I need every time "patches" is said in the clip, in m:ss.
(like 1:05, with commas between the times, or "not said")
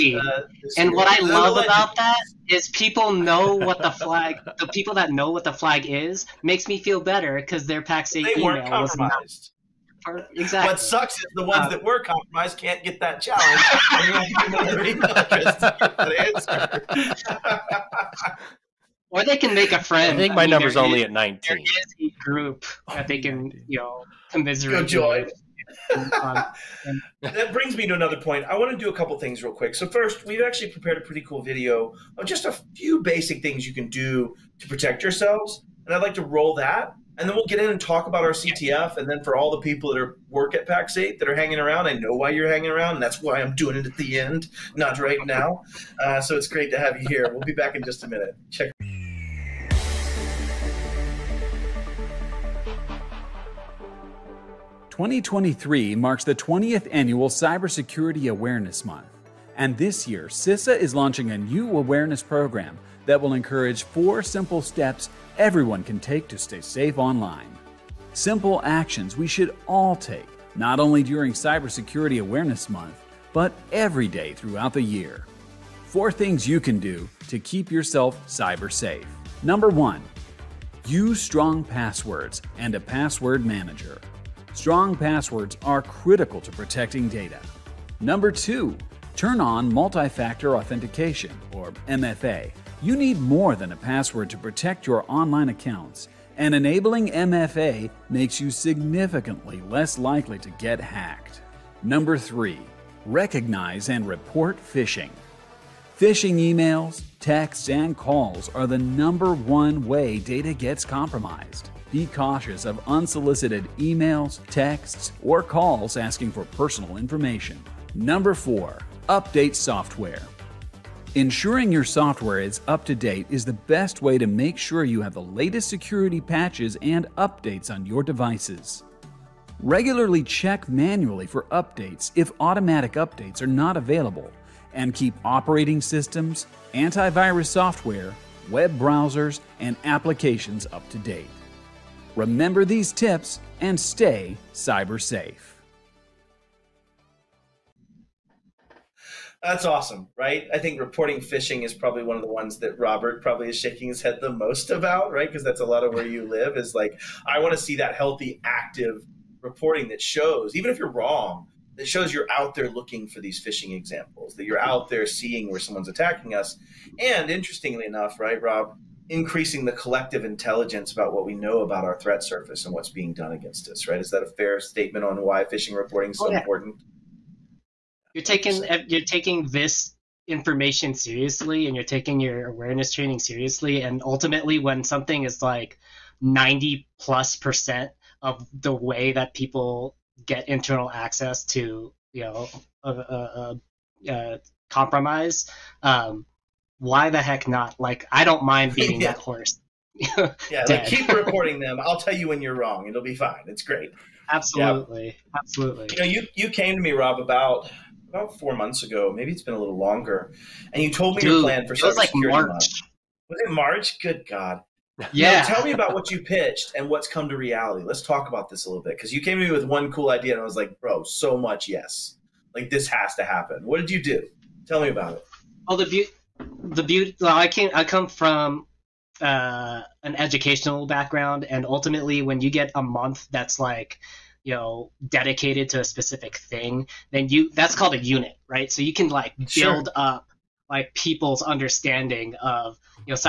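2:06.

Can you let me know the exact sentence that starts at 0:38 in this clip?
And then for all the people that are work at Pax8 that are hanging around, I know why you're hanging around.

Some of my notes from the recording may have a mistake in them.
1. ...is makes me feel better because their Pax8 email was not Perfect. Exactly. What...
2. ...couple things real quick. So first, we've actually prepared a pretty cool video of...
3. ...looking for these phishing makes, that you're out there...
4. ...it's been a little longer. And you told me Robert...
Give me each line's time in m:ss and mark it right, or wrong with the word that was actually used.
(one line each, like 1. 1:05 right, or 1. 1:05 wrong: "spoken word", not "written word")
1. 0:05 right
2. 0:28 right
3. 2:42 wrong: "examples", not "makes"
4. 3:29 wrong: "Dude", not "Robert".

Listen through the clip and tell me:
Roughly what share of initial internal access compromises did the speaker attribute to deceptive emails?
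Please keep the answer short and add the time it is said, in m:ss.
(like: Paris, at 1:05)
90 plus percent, at 3:06.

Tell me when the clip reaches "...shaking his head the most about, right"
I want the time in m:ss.
2:33.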